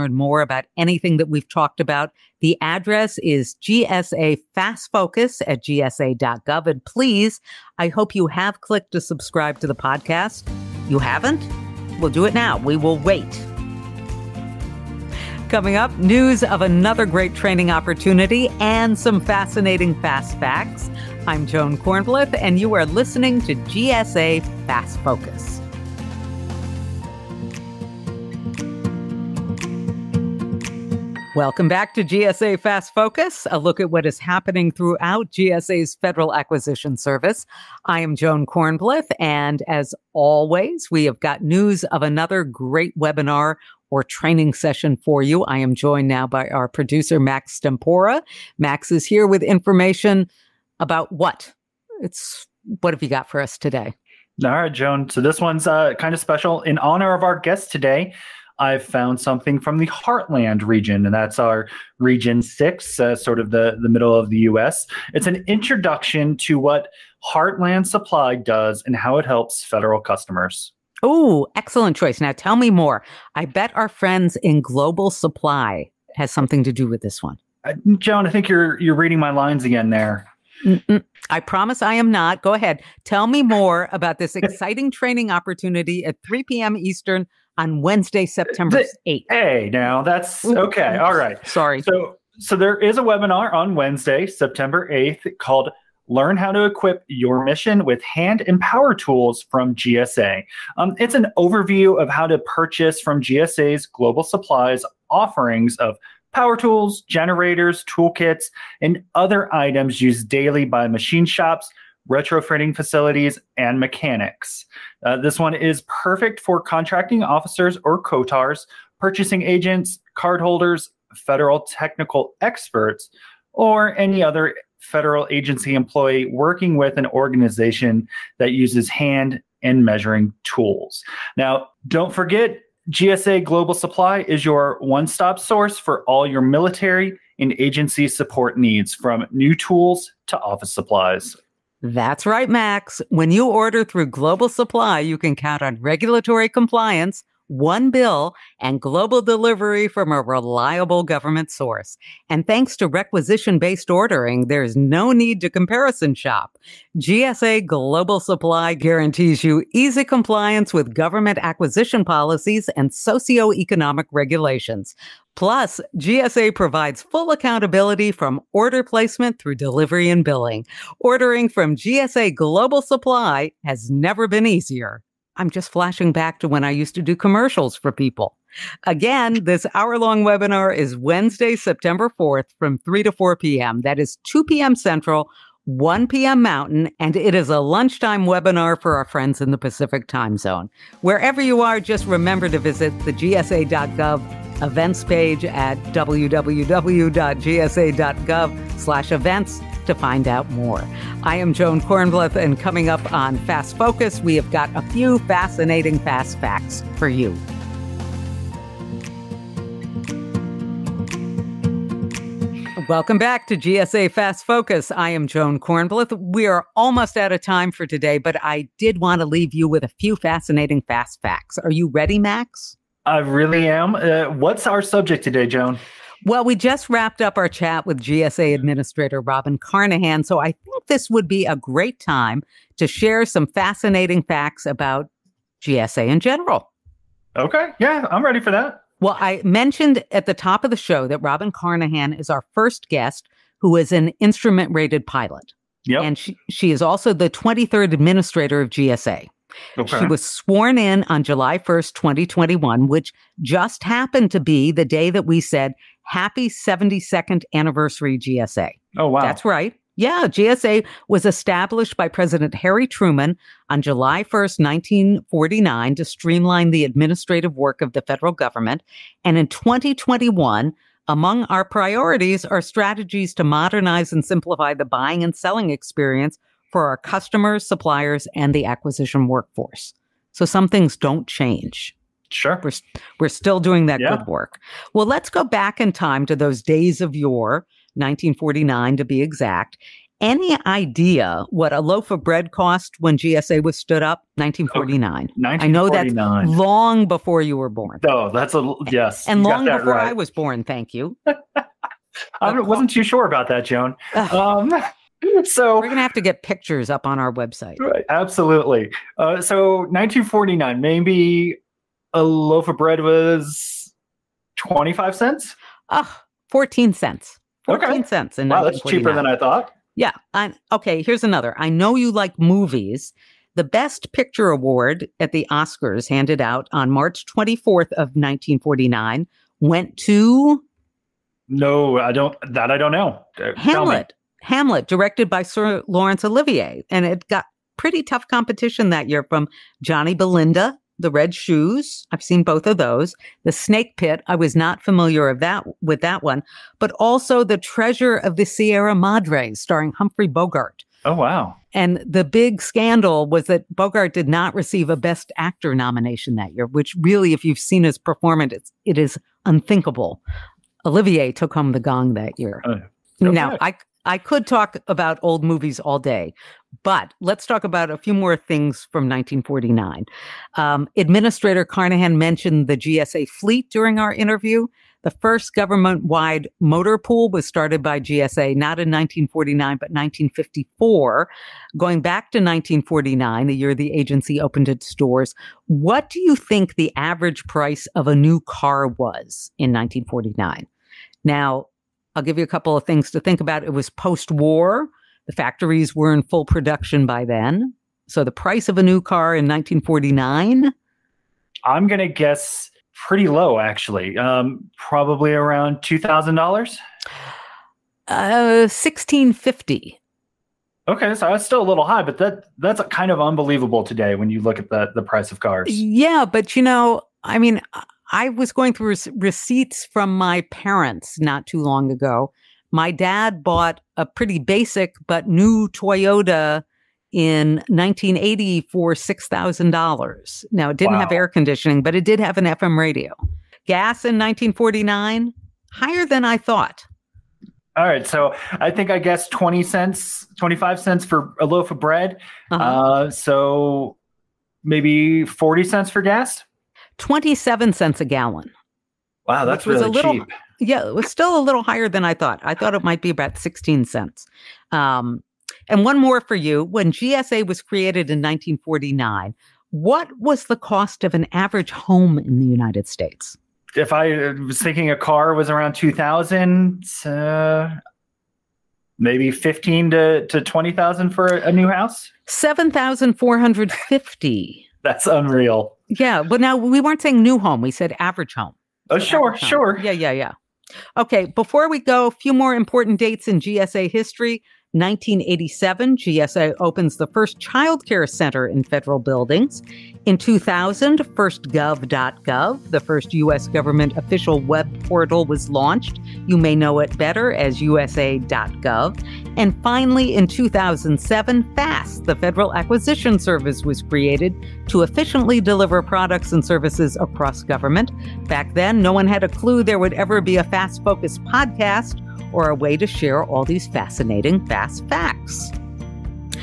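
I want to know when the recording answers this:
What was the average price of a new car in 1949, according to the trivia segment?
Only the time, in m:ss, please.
6:48.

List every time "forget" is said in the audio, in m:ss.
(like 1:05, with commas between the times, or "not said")
2:12.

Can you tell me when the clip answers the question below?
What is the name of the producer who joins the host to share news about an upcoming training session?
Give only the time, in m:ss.
0:47.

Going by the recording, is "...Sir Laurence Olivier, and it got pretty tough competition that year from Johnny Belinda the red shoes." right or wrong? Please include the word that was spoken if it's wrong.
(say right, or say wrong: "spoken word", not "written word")
right.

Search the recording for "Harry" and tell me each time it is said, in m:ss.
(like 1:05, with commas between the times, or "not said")
4:22.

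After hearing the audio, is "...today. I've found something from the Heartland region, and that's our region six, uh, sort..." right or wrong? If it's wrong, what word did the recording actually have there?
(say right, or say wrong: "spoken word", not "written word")
right.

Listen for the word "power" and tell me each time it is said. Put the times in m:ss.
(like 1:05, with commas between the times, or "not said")
1:38, 1:46.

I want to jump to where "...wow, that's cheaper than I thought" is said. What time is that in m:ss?
5:18.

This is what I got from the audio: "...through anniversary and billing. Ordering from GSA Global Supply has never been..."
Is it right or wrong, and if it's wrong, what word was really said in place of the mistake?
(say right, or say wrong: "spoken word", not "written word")
wrong: "delivery", not "anniversary".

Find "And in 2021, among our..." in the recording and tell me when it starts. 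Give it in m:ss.
4:29.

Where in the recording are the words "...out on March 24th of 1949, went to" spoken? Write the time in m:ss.
5:26.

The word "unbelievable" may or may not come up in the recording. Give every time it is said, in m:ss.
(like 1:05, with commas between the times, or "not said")
6:53.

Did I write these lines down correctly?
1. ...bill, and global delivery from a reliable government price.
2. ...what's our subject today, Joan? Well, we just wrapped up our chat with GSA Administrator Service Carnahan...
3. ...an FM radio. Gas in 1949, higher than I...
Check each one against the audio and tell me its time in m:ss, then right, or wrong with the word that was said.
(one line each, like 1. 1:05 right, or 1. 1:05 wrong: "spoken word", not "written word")
1. 2:27 wrong: "source", not "price"
2. 3:44 wrong: "Robin", not "Service"
3. 7:12 right.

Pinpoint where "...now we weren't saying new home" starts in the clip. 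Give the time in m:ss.
7:56.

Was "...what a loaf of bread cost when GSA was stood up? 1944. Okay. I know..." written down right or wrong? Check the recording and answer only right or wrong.
wrong.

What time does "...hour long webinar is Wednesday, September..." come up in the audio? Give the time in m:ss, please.
2:59.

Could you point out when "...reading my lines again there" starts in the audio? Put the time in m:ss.
1:18.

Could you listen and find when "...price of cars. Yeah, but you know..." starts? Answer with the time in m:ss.
6:55.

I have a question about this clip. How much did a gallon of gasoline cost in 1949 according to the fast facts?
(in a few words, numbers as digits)
27 cents.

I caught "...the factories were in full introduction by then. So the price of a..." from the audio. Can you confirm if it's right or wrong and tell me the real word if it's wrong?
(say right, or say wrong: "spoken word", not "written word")
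wrong: "production", not "introduction".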